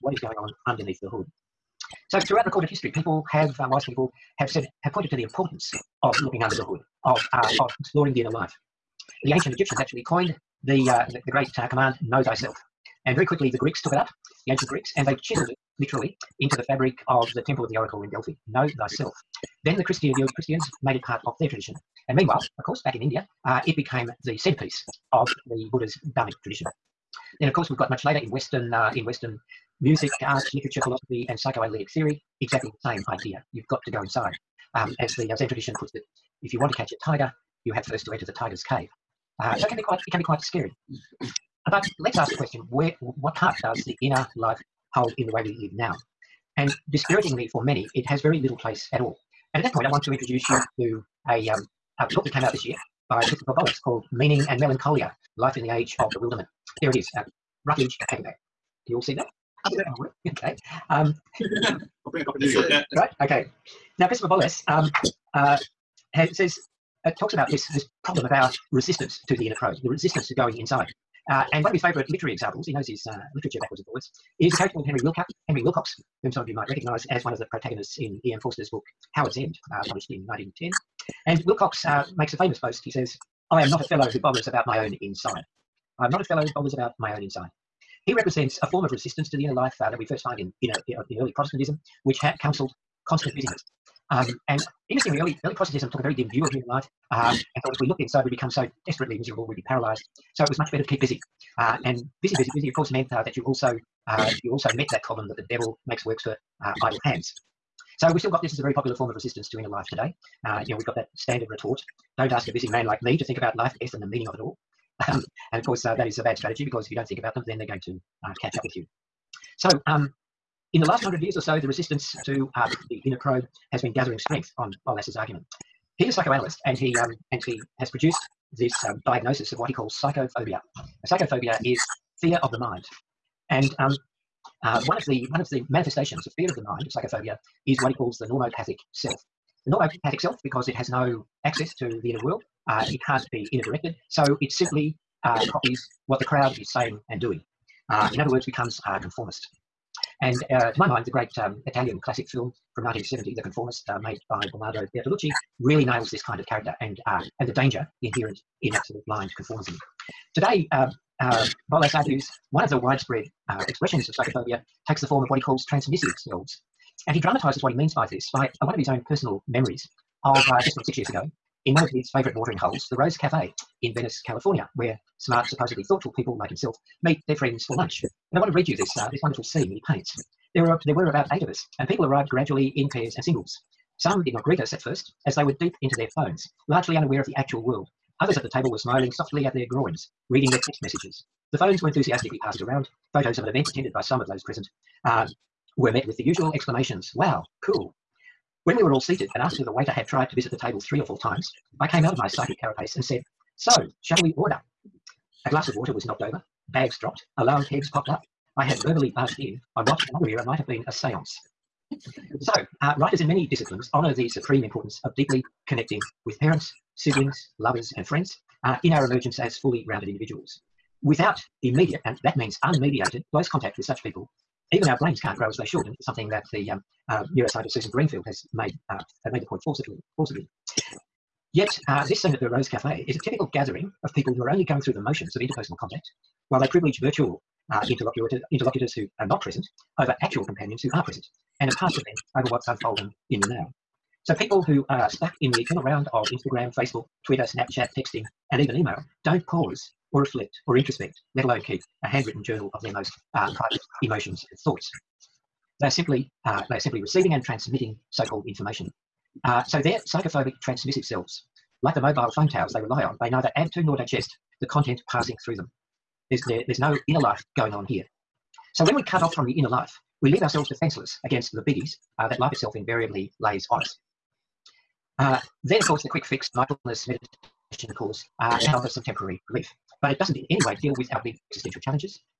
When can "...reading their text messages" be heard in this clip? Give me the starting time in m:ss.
3:10.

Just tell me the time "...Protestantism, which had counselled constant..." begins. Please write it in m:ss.
1:31.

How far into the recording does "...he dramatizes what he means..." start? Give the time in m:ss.
2:47.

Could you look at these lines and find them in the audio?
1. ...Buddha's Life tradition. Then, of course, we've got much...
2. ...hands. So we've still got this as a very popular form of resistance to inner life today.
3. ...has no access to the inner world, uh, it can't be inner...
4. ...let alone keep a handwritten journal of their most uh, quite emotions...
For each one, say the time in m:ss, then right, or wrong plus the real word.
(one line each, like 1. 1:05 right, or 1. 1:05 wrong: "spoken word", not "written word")
1. 0:25 wrong: "Dharmic", not "Life"
2. 1:47 right
3. 2:20 right
4. 4:11 wrong: "private", not "quite".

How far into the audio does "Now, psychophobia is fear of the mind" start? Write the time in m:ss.
2:10.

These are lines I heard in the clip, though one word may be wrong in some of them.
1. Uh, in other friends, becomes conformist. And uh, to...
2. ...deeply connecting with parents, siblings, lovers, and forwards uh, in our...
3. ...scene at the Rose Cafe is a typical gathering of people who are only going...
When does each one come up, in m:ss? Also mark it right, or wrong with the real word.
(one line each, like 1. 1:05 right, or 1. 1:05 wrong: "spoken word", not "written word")
1. 2:27 wrong: "words", not "friends"
2. 3:35 wrong: "friends", not "forwards"
3. 3:52 right.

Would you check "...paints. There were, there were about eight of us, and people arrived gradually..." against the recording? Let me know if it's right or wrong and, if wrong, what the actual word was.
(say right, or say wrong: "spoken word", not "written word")
right.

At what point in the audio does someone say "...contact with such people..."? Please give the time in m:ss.
3:43.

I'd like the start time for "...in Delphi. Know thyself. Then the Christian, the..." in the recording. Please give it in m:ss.
0:18.